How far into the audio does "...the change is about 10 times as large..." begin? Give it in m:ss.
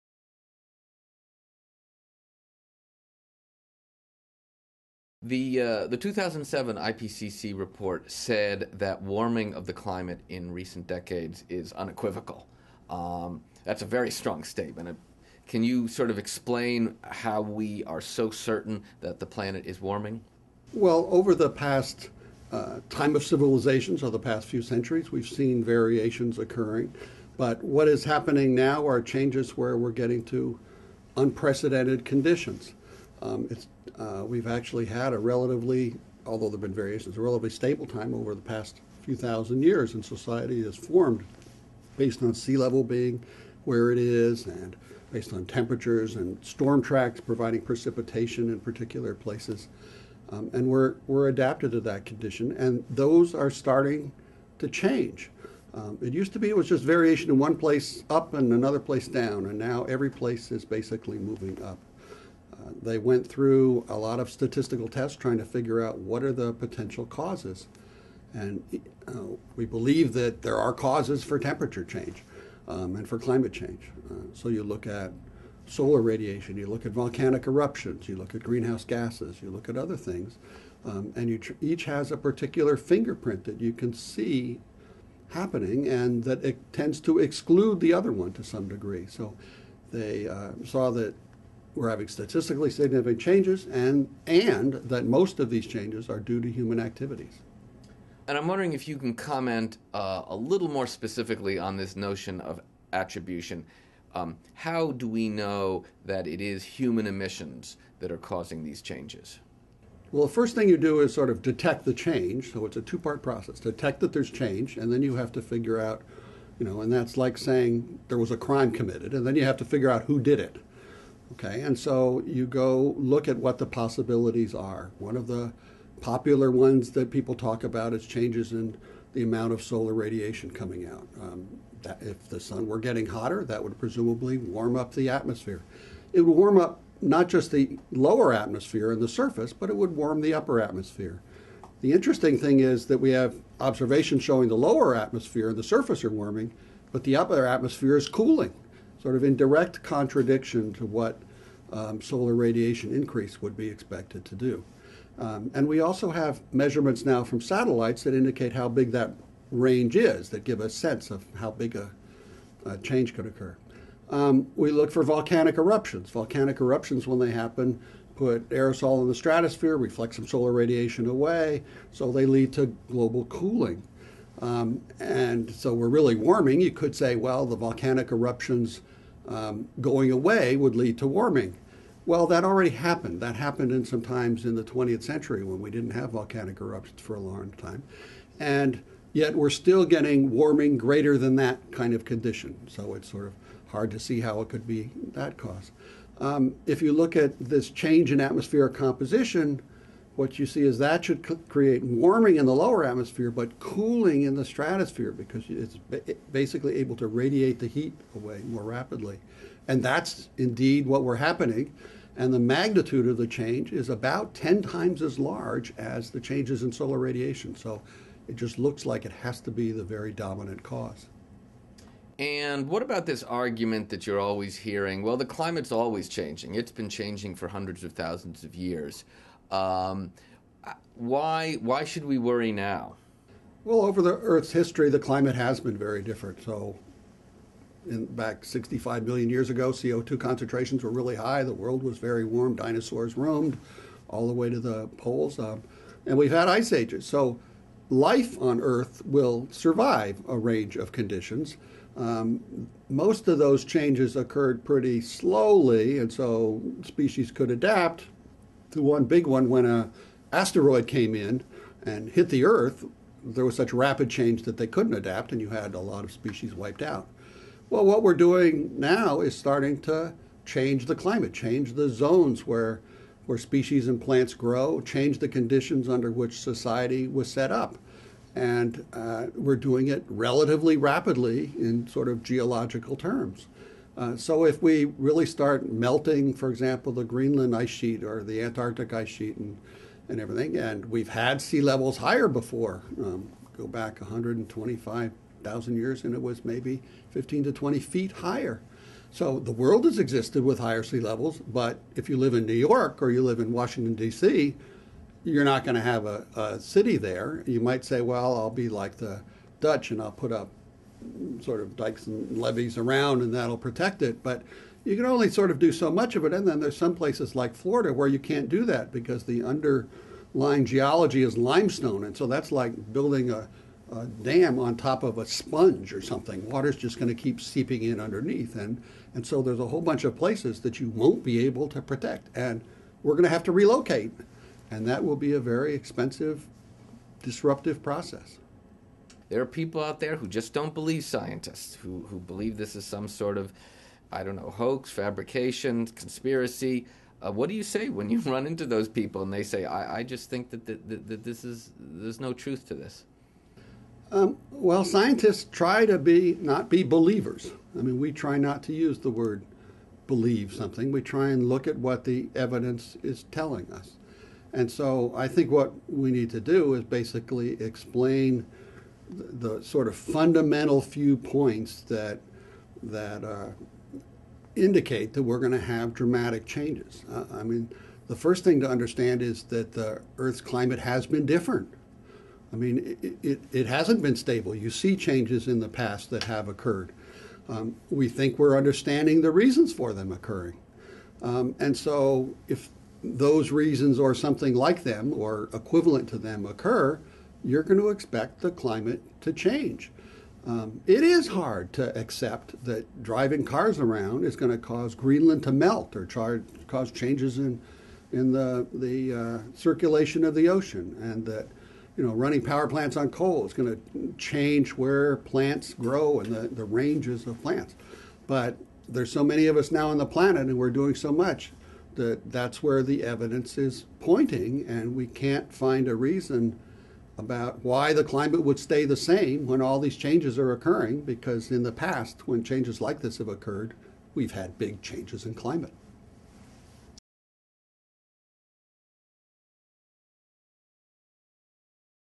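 3:33.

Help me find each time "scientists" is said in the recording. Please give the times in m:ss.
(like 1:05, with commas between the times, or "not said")
5:41, 5:54.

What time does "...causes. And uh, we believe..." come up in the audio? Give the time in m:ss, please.
1:07.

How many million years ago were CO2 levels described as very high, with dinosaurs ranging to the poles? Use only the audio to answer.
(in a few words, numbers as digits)
65 million.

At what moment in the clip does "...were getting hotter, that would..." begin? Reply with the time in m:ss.
2:12.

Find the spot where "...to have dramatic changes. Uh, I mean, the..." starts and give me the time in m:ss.
6:15.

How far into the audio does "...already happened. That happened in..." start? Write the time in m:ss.
3:02.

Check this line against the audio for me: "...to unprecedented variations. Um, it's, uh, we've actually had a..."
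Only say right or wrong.
wrong.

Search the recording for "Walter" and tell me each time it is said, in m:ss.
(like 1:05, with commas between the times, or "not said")
not said.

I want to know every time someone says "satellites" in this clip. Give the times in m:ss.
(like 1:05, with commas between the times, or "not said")
2:37.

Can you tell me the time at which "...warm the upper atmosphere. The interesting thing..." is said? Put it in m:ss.
2:19.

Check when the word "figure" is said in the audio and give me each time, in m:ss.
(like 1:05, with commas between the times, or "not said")
1:05, 1:55, 1:59.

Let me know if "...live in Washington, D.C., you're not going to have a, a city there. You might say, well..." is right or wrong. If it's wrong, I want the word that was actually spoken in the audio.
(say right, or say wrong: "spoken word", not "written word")
right.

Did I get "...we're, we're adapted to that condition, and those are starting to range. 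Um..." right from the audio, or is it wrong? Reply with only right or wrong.
wrong.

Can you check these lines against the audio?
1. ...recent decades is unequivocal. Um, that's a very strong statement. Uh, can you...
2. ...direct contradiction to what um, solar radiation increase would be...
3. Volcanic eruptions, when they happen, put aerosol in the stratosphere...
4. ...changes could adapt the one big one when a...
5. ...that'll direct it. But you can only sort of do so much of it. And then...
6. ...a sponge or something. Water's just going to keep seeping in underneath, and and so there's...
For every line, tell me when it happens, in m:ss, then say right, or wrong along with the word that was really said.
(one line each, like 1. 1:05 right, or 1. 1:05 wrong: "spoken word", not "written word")
1. 0:10 right
2. 2:29 right
3. 2:46 right
4. 4:16 wrong: "species", not "changes"
5. 5:13 wrong: "protect", not "direct"
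6. 5:25 right.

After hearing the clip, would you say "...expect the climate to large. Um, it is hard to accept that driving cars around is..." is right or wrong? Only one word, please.
wrong.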